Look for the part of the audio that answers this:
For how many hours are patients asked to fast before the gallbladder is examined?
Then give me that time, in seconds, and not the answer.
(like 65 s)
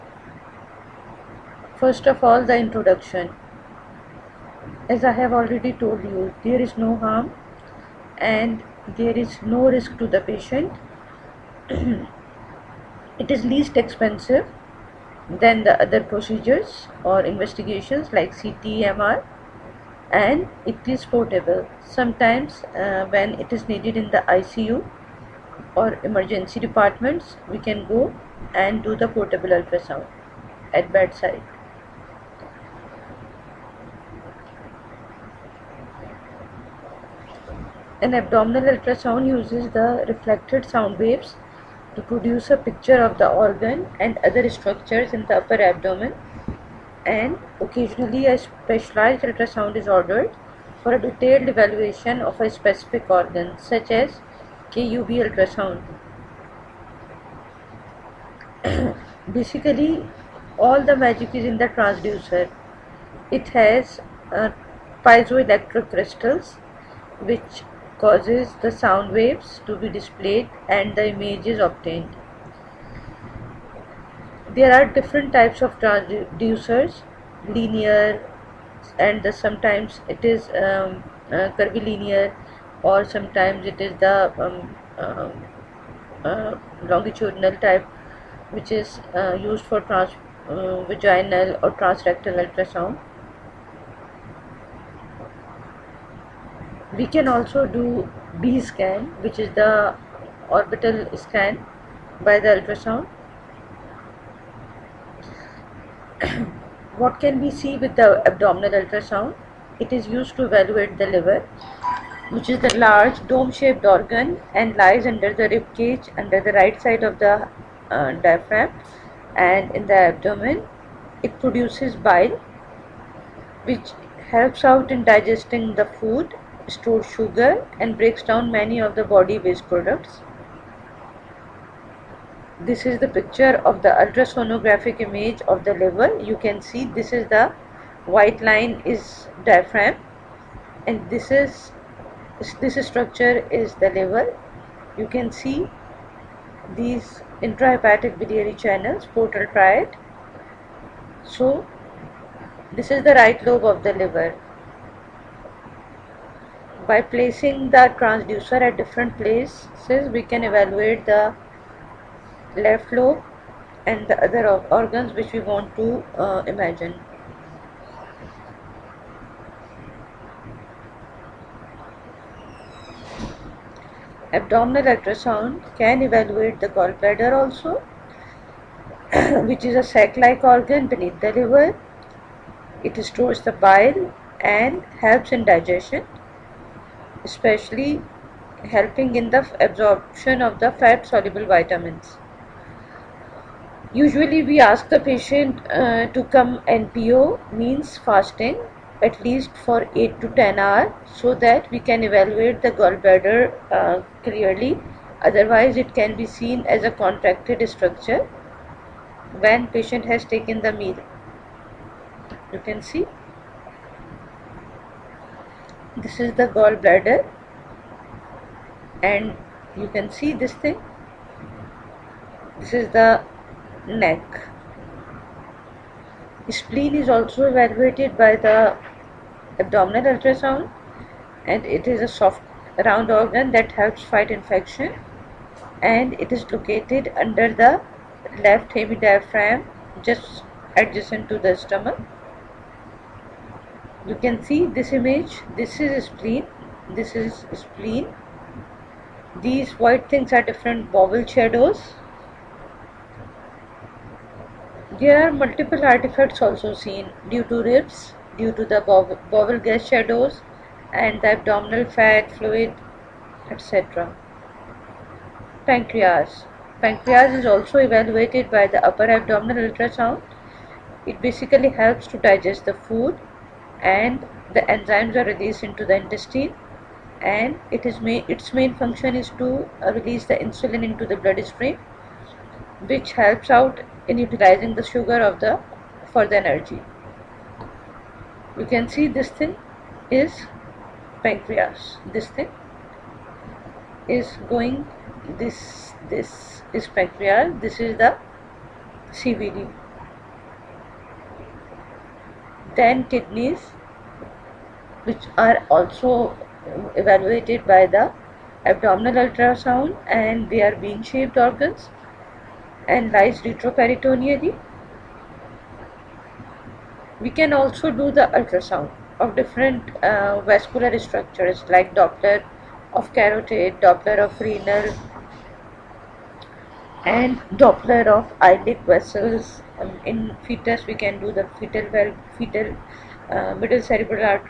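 199 s.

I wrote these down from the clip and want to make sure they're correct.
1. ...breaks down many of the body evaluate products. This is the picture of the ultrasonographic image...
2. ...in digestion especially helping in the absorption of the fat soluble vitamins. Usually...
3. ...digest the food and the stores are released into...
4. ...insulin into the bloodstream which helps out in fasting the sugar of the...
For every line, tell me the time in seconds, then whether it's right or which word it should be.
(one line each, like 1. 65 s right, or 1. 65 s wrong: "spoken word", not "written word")
1. 127 s wrong: "waste", not "evaluate"
2. 185 s right
3. 272 s wrong: "enzymes", not "stores"
4. 280 s wrong: "utilizing", not "fasting".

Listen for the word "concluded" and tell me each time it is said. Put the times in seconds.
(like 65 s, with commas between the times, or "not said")
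not said.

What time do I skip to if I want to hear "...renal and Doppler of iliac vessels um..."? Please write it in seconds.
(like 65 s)
324 s.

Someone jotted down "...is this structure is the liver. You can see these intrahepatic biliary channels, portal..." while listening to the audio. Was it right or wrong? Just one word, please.
right.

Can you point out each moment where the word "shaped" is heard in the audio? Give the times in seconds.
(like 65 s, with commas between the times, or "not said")
113 s, 311 s.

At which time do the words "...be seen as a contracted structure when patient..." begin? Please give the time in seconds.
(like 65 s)
206 s.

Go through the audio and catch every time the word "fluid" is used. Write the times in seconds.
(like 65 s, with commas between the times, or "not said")
262 s.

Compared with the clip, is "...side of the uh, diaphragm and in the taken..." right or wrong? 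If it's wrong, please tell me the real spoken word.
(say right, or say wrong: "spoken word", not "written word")
wrong: "abdomen", not "taken".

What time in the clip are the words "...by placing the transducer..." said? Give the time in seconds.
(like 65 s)
156 s.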